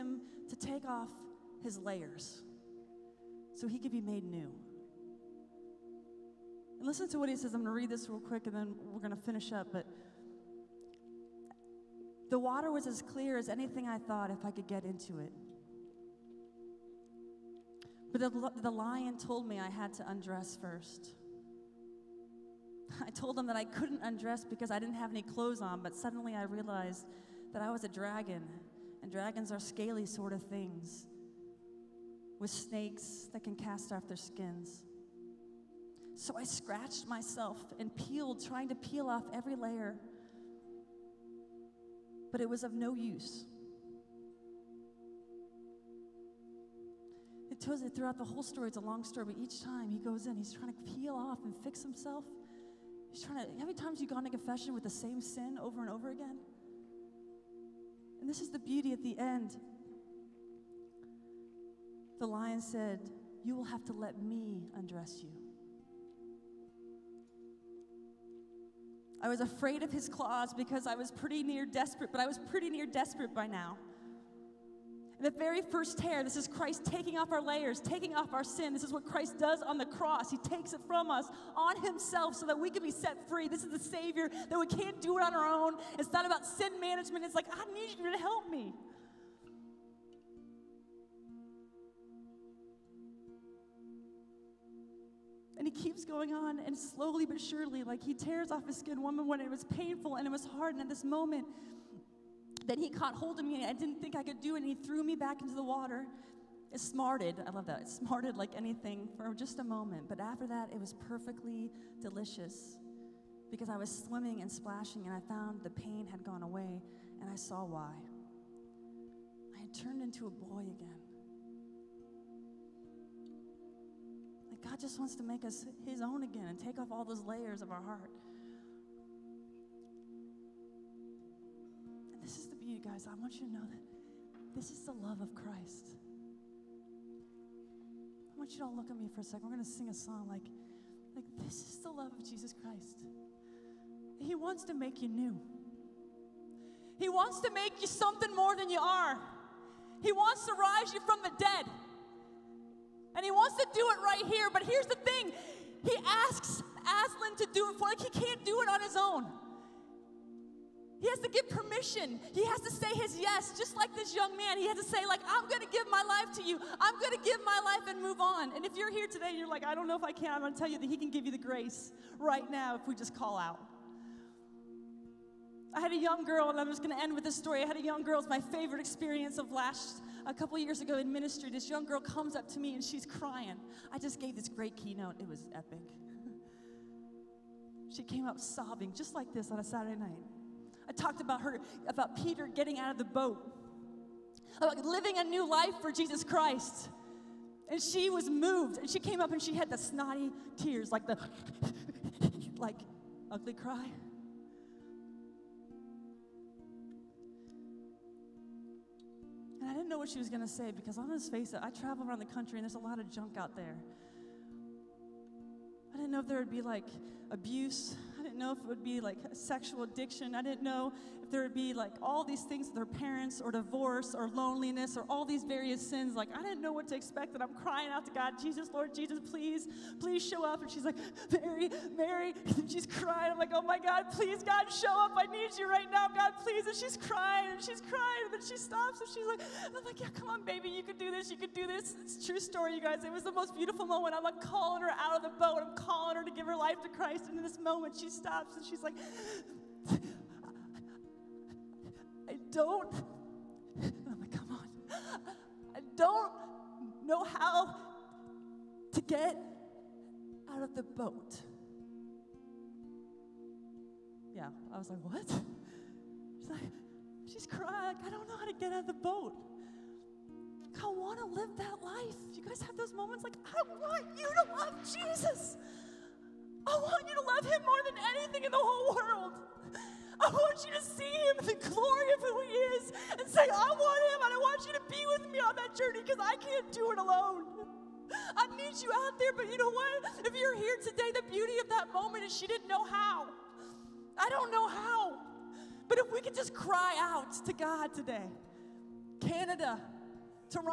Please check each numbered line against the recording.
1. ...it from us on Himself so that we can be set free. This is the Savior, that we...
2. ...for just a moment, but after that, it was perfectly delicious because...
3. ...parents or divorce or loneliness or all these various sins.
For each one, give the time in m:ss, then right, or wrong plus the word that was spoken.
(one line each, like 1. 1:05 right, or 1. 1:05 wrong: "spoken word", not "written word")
1. 1:20 right
2. 1:49 right
3. 3:42 right.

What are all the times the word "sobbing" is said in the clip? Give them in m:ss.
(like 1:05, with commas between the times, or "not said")
3:08.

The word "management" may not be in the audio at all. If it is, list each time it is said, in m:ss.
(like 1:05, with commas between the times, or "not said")
1:26.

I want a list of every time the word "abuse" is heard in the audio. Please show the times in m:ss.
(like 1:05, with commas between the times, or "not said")
3:37.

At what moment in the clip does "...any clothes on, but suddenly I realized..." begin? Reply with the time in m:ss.
0:25.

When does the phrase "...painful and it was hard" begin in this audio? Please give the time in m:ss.
1:39.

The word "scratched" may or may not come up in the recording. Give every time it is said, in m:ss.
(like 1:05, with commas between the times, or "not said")
0:36.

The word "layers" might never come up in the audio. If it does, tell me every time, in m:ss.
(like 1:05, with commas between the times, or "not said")
0:01, 0:39, 1:17, 2:07.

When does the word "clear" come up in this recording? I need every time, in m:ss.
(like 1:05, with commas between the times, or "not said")
0:13.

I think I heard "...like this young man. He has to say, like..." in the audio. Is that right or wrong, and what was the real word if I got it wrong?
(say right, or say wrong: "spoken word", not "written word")
right.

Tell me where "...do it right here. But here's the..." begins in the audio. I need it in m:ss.
2:33.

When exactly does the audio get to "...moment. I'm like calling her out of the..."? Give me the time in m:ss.
4:03.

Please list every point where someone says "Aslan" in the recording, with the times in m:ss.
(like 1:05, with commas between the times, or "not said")
2:36.